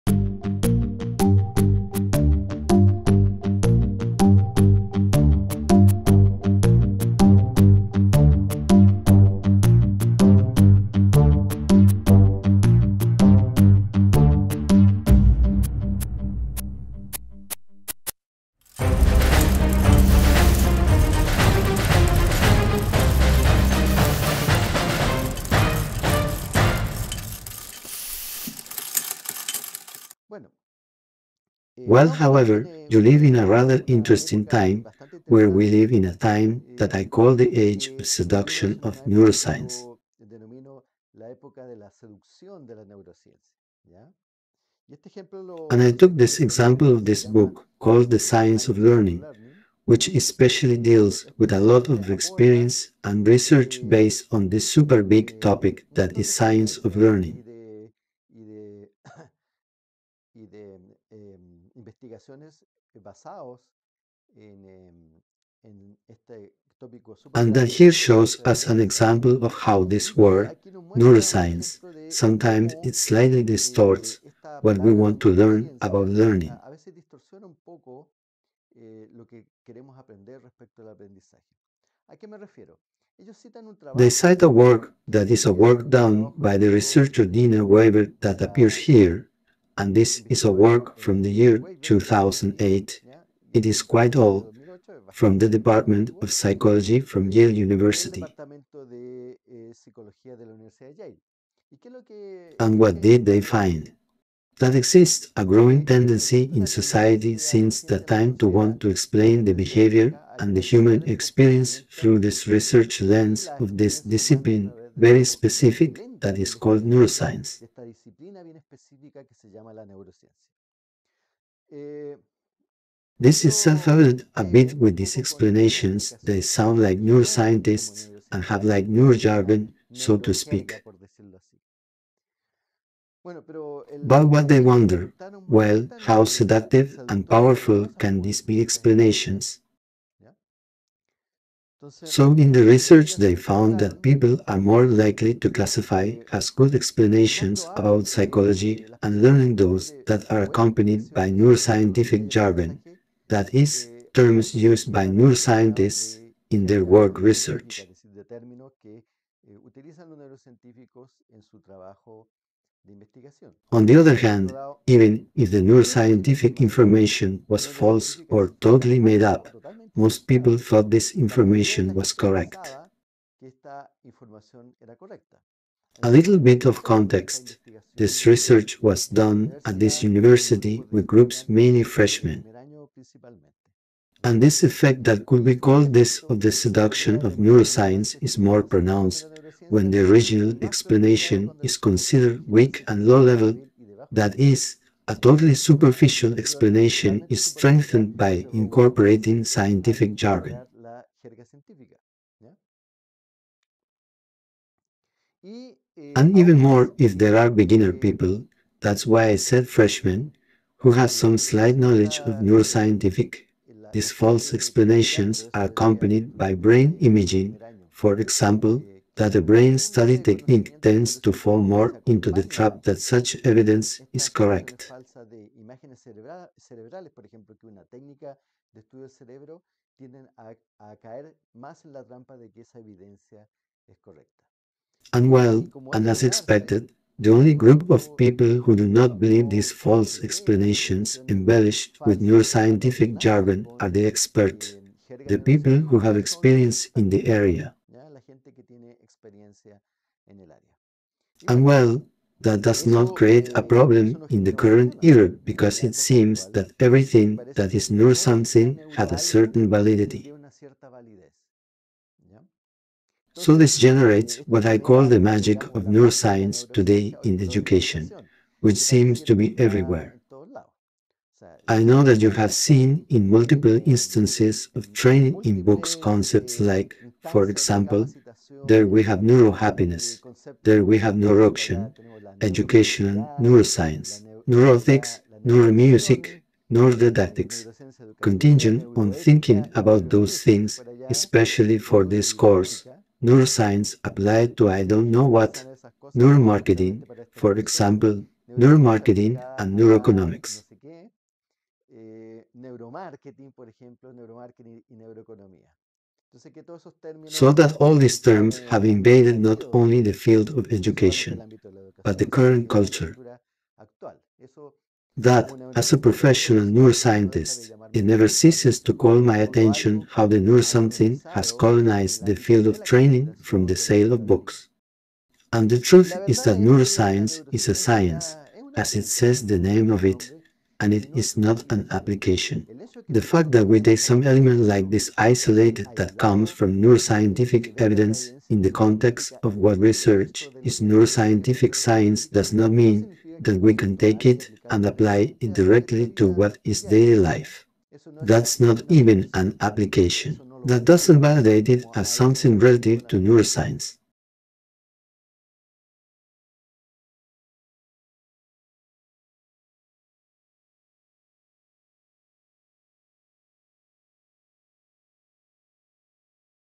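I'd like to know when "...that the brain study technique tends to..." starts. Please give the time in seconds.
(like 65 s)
219 s.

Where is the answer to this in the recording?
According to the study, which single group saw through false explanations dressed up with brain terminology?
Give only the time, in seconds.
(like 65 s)
243 s.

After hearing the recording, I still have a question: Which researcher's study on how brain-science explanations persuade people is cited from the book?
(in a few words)
Dina Weber.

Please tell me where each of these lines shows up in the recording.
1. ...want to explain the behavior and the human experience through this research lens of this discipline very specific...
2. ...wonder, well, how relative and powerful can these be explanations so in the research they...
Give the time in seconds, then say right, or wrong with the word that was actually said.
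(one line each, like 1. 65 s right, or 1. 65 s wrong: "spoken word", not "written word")
1. 108 s right
2. 134 s wrong: "seductive", not "relative".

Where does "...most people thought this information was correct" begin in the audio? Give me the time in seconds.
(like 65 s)
169 s.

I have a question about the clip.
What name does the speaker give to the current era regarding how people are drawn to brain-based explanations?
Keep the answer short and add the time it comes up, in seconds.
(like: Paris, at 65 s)
age of seduction of neuroscience, at 37 s.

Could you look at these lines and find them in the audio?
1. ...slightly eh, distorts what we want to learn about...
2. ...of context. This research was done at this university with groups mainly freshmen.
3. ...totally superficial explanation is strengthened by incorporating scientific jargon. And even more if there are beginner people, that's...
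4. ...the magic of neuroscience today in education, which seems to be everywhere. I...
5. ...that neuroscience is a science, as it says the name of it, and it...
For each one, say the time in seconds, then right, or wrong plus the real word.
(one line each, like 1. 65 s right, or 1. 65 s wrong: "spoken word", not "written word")
1. 73 s right
2. 176 s right
3. 195 s right
4. 265 s right
5. 326 s right.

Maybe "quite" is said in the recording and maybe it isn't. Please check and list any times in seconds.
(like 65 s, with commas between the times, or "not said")
93 s.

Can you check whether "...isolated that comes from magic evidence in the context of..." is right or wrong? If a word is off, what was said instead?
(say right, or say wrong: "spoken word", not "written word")
wrong: "neuroscientific", not "magic".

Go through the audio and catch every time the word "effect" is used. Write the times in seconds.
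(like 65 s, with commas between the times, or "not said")
184 s.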